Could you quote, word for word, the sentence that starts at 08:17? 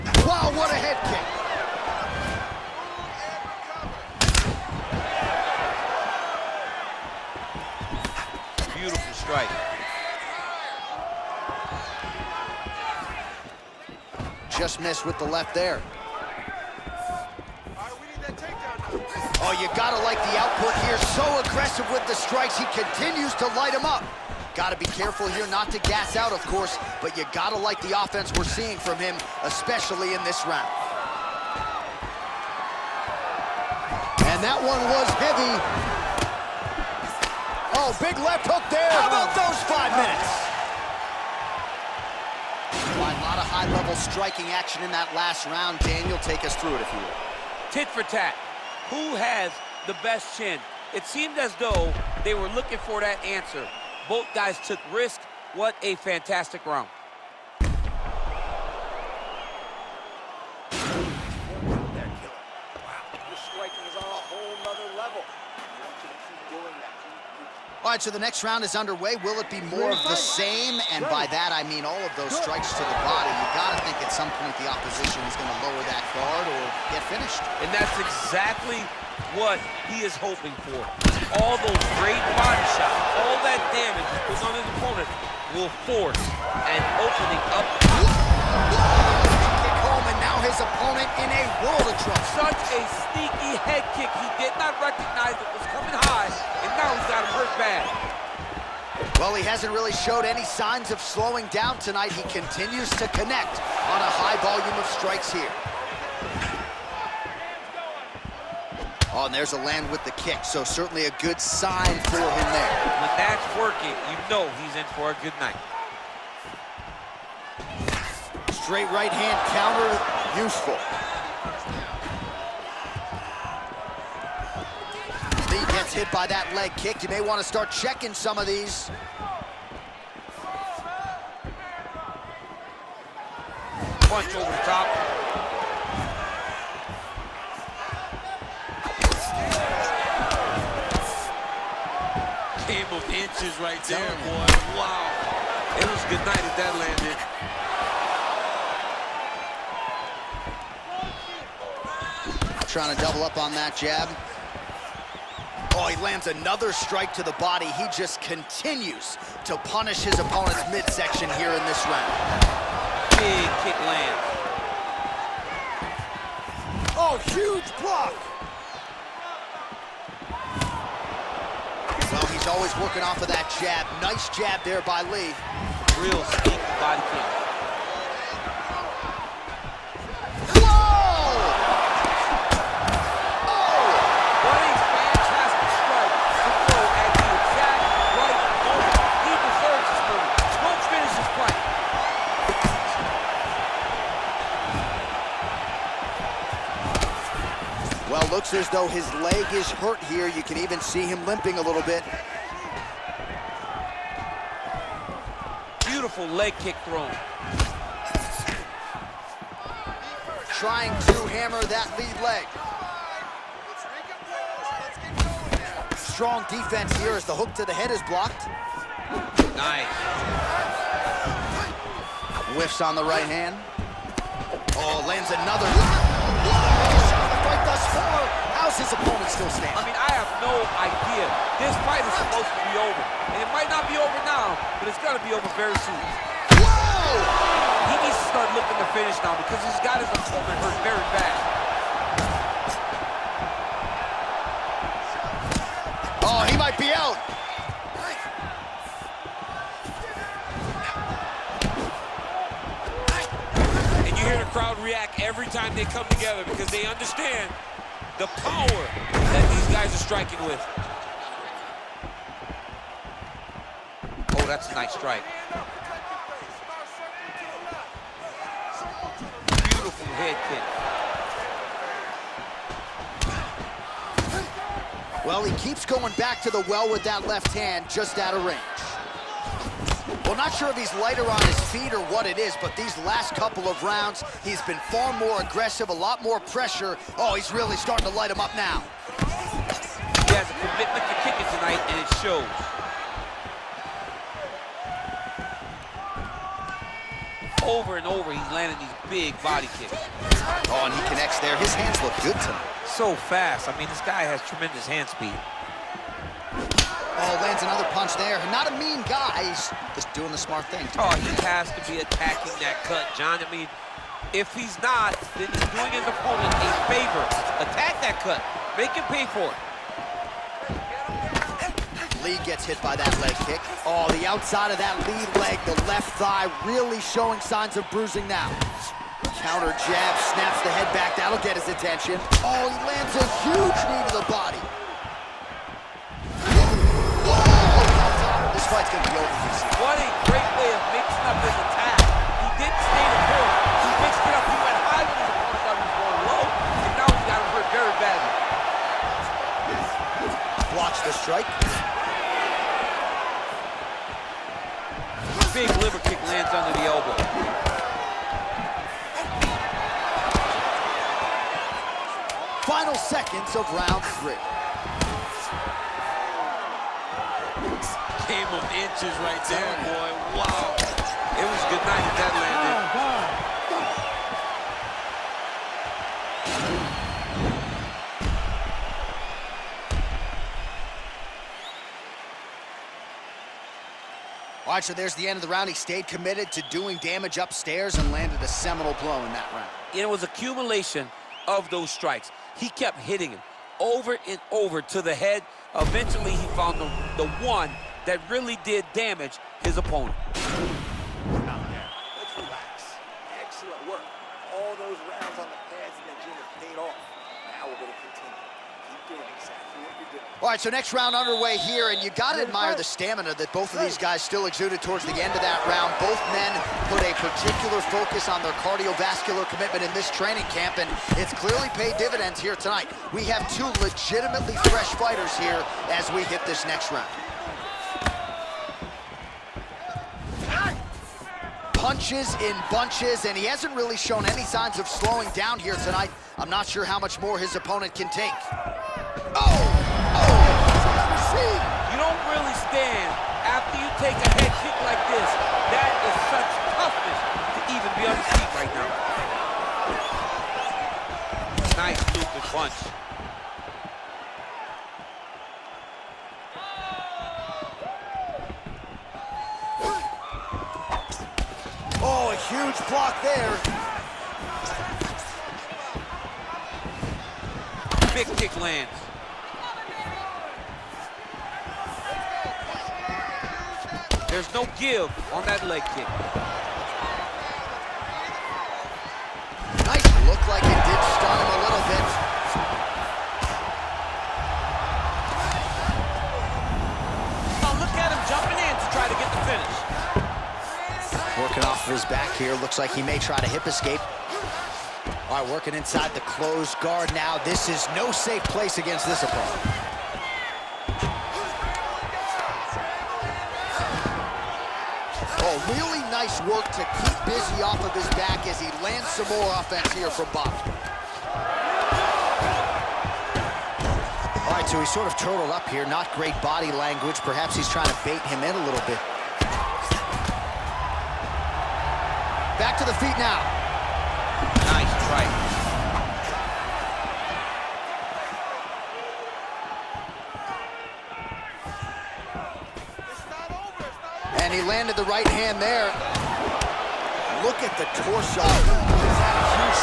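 This is no safe place against this opponent.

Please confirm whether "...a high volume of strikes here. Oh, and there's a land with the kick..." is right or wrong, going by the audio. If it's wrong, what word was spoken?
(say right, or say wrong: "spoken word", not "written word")
right.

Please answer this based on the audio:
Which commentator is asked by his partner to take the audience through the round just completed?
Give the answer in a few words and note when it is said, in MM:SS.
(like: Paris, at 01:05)
Daniel, at 00:45.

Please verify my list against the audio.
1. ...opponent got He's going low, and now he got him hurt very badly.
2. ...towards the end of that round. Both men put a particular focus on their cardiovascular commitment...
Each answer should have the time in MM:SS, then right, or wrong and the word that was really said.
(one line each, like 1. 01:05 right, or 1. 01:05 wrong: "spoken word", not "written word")
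1. 05:45 right
2. 06:54 right.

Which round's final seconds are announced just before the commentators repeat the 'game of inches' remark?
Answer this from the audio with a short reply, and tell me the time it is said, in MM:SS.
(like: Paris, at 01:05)
3, at 06:04.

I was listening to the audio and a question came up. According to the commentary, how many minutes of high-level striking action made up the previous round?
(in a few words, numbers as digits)
5.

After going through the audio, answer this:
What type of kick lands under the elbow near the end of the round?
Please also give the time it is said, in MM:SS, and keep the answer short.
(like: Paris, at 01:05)
liver kick, at 05:55.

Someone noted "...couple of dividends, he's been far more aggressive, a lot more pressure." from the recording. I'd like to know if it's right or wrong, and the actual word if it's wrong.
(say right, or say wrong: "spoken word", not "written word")
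wrong: "rounds", not "dividends".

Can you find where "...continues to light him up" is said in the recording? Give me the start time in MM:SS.
00:22.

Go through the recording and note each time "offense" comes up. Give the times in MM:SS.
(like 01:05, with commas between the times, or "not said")
00:28, 08:29.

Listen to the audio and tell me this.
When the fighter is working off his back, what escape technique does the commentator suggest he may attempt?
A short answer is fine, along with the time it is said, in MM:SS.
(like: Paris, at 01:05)
hip escape, at 08:13.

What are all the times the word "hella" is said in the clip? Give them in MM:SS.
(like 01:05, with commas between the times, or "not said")
not said.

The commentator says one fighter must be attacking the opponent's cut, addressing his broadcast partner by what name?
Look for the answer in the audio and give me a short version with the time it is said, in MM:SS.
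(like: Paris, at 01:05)
John, at 05:13.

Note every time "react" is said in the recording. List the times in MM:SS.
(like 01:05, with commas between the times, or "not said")
04:14.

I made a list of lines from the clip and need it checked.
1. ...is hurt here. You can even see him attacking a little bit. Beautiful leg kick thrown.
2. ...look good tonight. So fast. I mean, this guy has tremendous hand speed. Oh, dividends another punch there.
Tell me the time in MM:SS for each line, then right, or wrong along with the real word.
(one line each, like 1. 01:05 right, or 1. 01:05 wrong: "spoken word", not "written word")
1. 03:19 wrong: "limping", not "attacking"
2. 05:02 wrong: "lands", not "dividends".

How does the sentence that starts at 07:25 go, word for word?
That is such toughness to even be on the feet right now.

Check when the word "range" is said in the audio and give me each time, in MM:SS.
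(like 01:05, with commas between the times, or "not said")
04:38.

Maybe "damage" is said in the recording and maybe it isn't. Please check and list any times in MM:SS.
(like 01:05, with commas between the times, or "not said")
01:23, 06:26, 06:38.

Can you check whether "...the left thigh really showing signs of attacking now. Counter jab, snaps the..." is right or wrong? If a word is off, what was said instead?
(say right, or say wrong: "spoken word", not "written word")
wrong: "bruising", not "attacking".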